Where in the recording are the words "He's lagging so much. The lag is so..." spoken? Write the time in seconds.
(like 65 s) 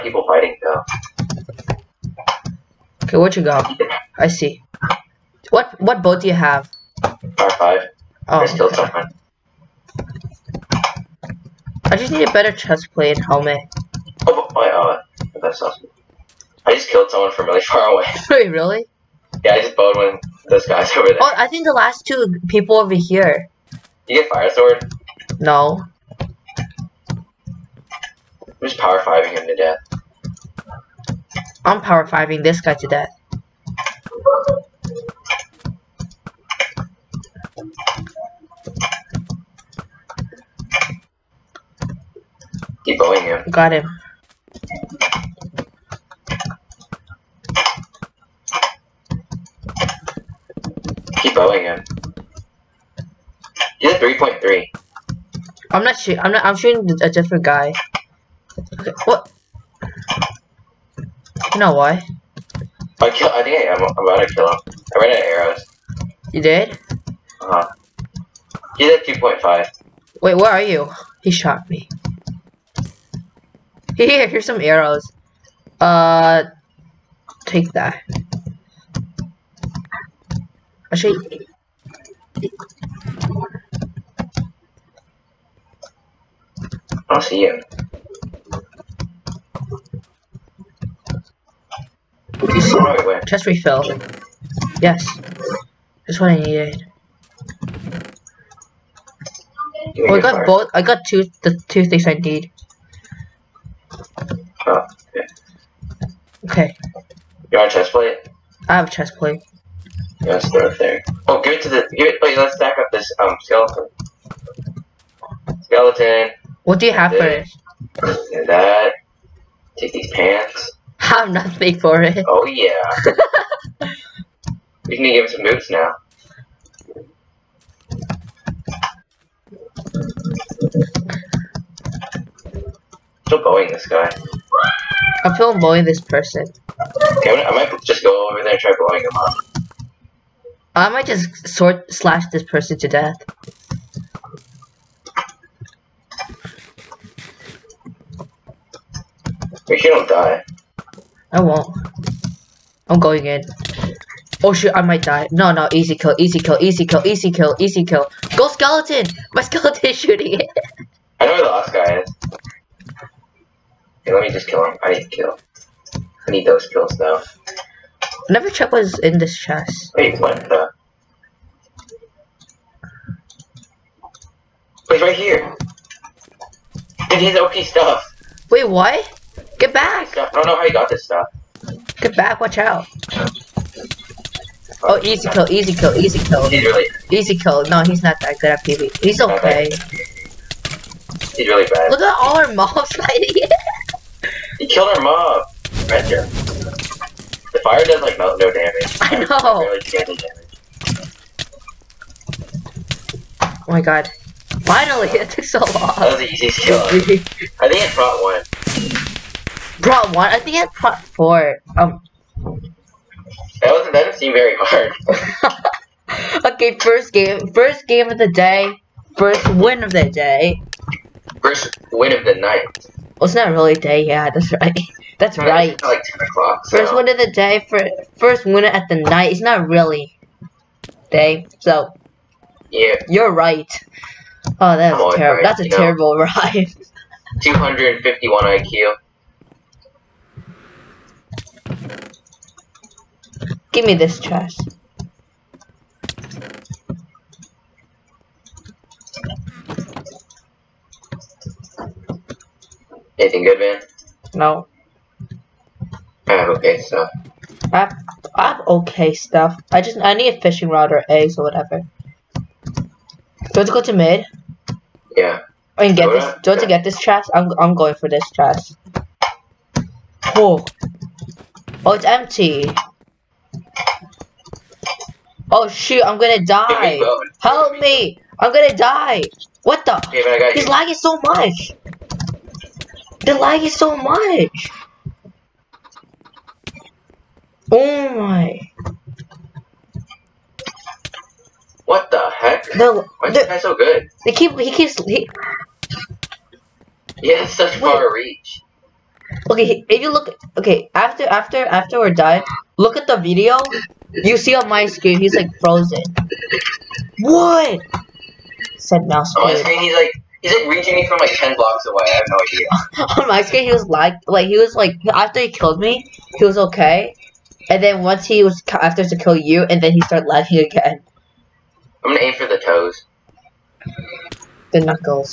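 280 s.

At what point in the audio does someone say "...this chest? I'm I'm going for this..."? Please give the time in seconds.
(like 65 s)
266 s.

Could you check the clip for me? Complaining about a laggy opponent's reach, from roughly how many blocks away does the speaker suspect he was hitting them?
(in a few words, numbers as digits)
10 blocks.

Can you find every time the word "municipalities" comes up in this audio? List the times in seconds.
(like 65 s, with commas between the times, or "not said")
not said.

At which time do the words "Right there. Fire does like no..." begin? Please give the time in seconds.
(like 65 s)
195 s.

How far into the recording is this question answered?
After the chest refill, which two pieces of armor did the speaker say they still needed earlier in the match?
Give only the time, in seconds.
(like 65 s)
12 s.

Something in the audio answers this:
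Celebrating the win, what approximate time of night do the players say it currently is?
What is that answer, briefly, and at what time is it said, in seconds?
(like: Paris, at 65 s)
10 o'clock, at 226 s.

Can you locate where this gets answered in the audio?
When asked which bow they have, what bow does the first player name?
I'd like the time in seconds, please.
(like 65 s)
7 s.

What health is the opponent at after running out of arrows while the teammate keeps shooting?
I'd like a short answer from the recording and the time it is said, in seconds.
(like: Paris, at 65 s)
2.5, at 69 s.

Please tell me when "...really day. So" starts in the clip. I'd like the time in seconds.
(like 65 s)
229 s.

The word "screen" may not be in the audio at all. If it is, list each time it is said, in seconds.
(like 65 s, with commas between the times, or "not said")
304 s, 313 s.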